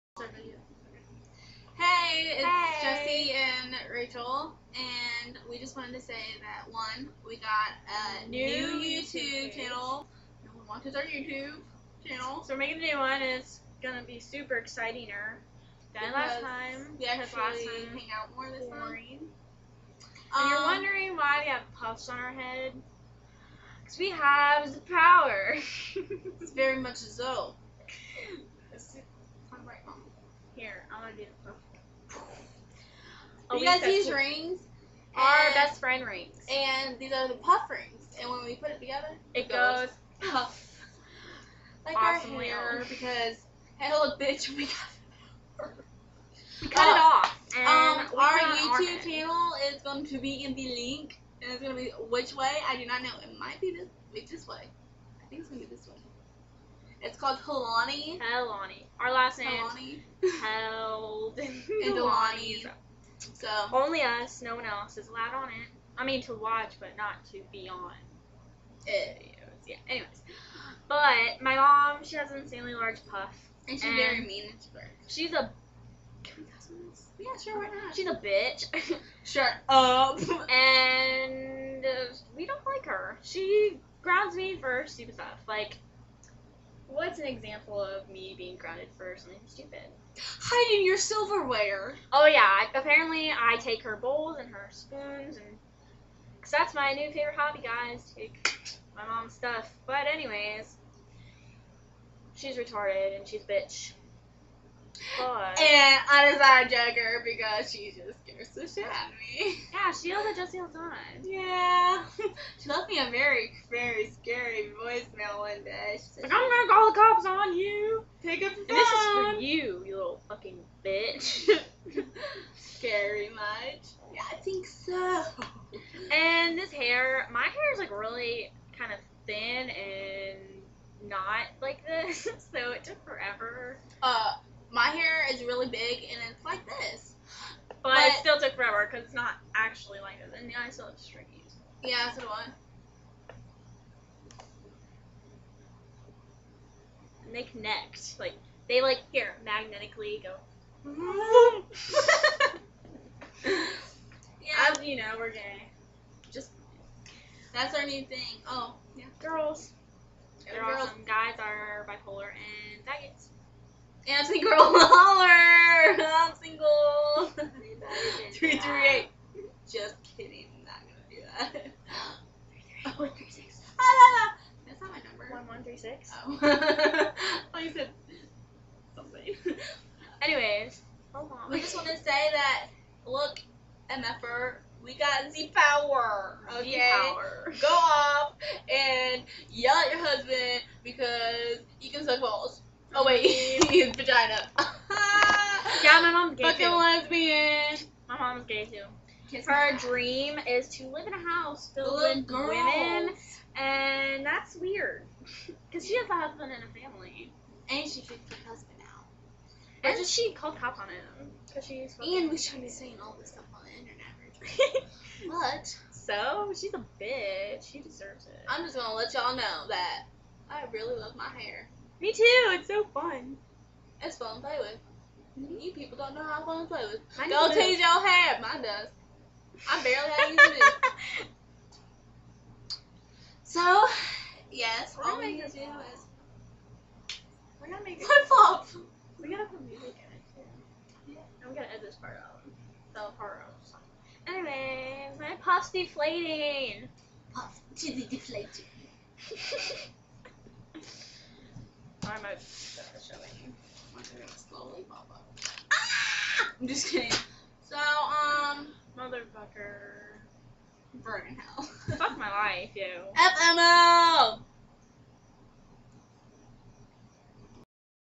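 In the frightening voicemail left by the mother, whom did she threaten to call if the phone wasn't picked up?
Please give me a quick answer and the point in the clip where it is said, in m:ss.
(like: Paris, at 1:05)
the cops, at 1:56.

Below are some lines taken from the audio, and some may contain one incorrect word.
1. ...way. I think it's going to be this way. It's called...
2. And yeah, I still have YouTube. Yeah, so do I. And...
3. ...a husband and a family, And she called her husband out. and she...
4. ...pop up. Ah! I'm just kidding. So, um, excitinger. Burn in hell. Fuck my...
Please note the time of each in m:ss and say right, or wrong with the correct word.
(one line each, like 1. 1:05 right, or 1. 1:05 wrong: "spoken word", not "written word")
1. 0:54 right
2. 2:20 wrong: "Strickies", not "YouTube"
3. 3:26 wrong: "kicked", not "called"
4. 4:14 wrong: "motherfucker", not "excitinger".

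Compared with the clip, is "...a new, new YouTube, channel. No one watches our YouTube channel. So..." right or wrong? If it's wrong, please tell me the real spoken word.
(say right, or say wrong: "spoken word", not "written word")
right.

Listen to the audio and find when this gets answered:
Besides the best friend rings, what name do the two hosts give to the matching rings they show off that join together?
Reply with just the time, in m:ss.
0:37.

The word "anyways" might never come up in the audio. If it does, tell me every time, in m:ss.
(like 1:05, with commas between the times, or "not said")
1:09, 1:40, 3:00, 4:04.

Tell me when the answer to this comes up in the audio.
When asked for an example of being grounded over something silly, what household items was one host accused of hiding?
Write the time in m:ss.
1:30.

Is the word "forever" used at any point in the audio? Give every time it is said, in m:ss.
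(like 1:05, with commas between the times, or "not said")
2:13, 2:18.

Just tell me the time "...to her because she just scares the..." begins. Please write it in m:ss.
1:46.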